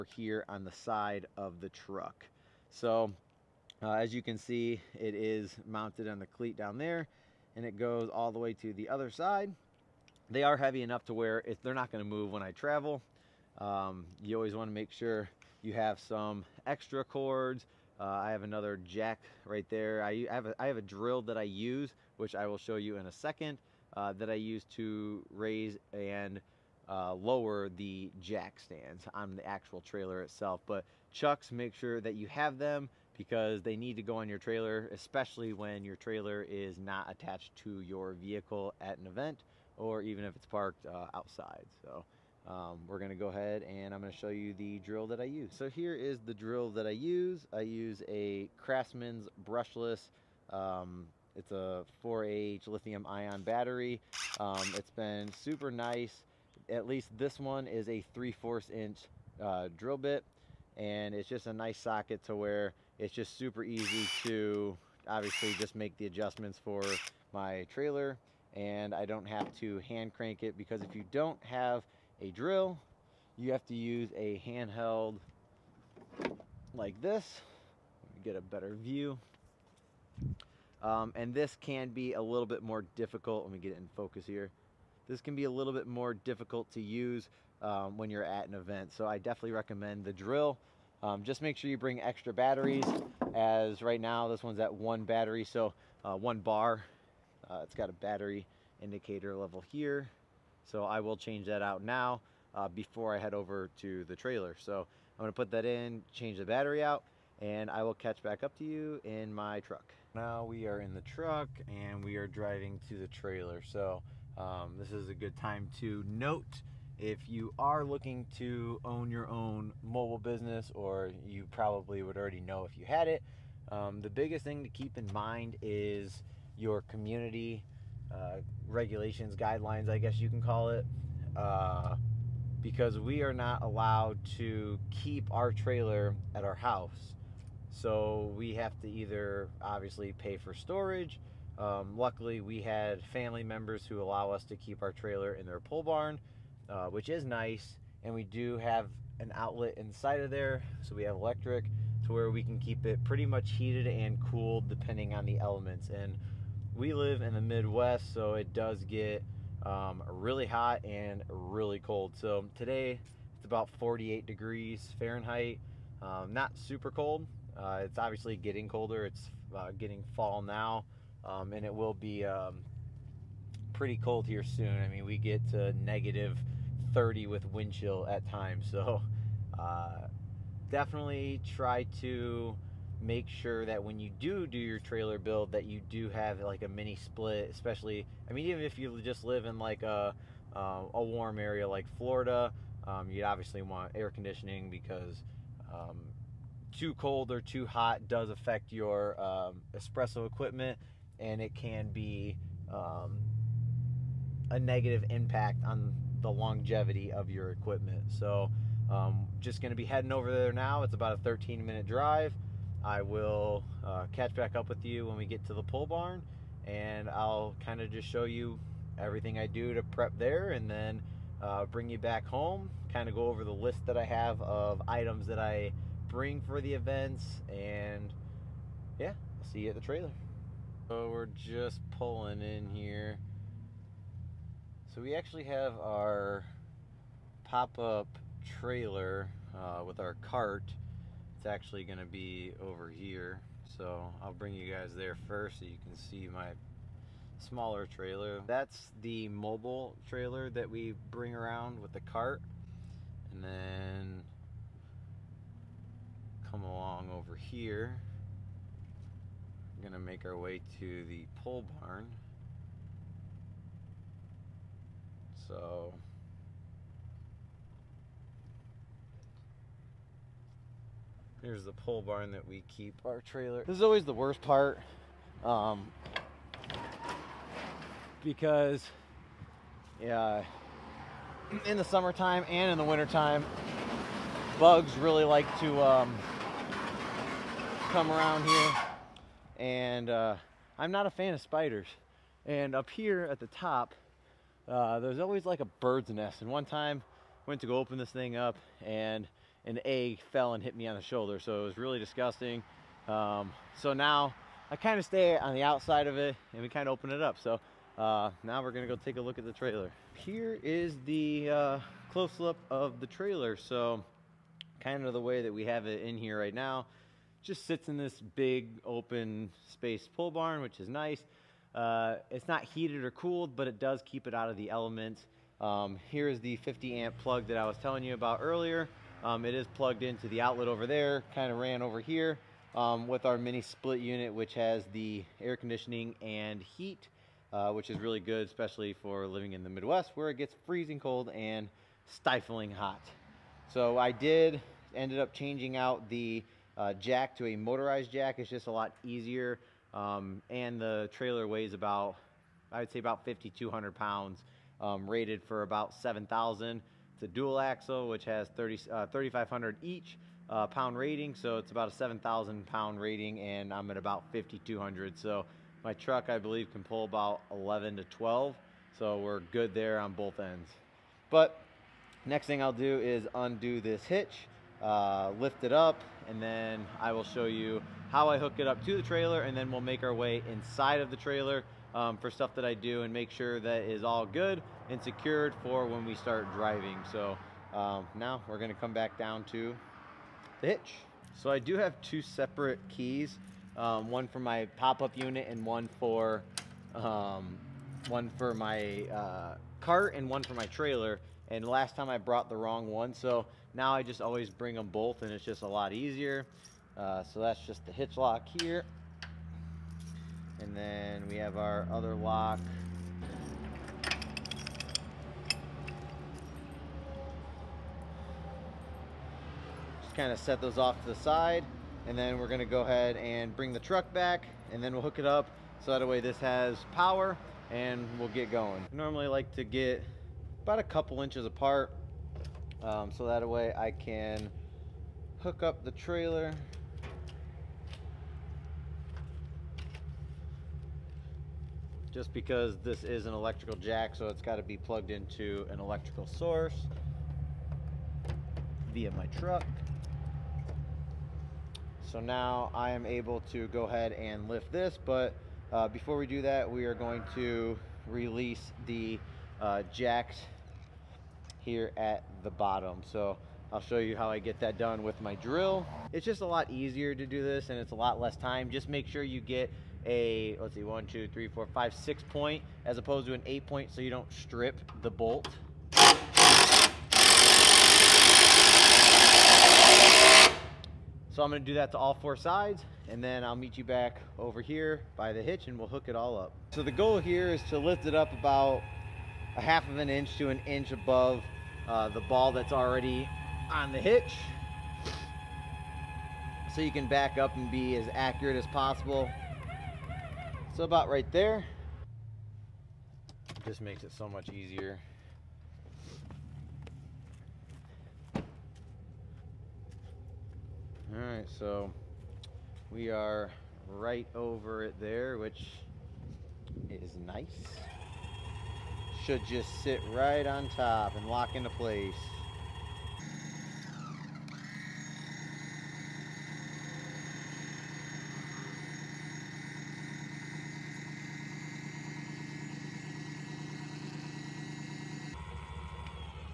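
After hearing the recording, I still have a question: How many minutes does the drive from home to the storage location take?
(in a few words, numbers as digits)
13.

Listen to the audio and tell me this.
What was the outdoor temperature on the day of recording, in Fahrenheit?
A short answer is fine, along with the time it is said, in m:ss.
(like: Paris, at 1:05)
48 degrees, at 2:43.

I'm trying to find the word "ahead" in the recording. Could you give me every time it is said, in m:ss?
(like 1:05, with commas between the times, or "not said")
0:43, 7:02, 7:33.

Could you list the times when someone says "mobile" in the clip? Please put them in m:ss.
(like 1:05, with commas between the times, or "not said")
1:59, 4:09.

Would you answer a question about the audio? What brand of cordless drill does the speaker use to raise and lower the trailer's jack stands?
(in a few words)
Craftsman.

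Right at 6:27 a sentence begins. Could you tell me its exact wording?
So um, now we're gonna come back down to the hitch.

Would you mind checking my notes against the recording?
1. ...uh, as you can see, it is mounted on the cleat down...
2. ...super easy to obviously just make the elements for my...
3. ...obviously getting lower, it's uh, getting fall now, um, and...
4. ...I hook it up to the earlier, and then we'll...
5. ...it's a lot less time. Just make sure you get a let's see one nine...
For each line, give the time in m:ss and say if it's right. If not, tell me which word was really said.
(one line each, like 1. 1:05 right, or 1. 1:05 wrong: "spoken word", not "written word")
1. 0:03 right
2. 1:03 wrong: "adjustments", not "elements"
3. 2:47 wrong: "colder", not "lower"
4. 6:18 wrong: "trailer", not "earlier"
5. 7:47 wrong: "two", not "nine".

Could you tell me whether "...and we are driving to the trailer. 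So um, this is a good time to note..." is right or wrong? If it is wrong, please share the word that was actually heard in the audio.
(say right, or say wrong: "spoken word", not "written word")
right.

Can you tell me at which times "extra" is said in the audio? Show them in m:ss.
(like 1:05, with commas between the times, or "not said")
0:16, 1:31.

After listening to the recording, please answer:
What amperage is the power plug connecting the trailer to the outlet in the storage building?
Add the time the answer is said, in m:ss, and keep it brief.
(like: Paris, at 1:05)
50 amp, at 5:26.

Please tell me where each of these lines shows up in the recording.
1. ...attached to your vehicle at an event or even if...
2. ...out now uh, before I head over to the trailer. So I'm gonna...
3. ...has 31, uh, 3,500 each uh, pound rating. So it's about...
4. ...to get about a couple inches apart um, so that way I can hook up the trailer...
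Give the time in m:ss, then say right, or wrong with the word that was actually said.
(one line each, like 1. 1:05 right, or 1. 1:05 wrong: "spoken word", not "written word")
1. 0:37 right
2. 1:41 right
3. 5:58 wrong: "30", not "31"
4. 7:09 right.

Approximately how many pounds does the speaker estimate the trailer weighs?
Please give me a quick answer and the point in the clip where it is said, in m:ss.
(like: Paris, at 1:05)
5,200, at 5:53.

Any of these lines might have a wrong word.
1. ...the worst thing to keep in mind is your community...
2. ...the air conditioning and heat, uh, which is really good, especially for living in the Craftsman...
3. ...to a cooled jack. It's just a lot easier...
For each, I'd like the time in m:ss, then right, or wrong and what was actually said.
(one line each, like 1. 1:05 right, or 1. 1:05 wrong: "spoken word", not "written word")
1. 2:04 wrong: "biggest", not "worst"
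2. 5:34 wrong: "Midwest", not "Craftsman"
3. 5:47 wrong: "motorized", not "cooled".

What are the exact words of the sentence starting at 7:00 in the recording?
Just kind of set those off to the side.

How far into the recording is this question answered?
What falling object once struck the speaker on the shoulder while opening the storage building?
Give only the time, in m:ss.
4:59.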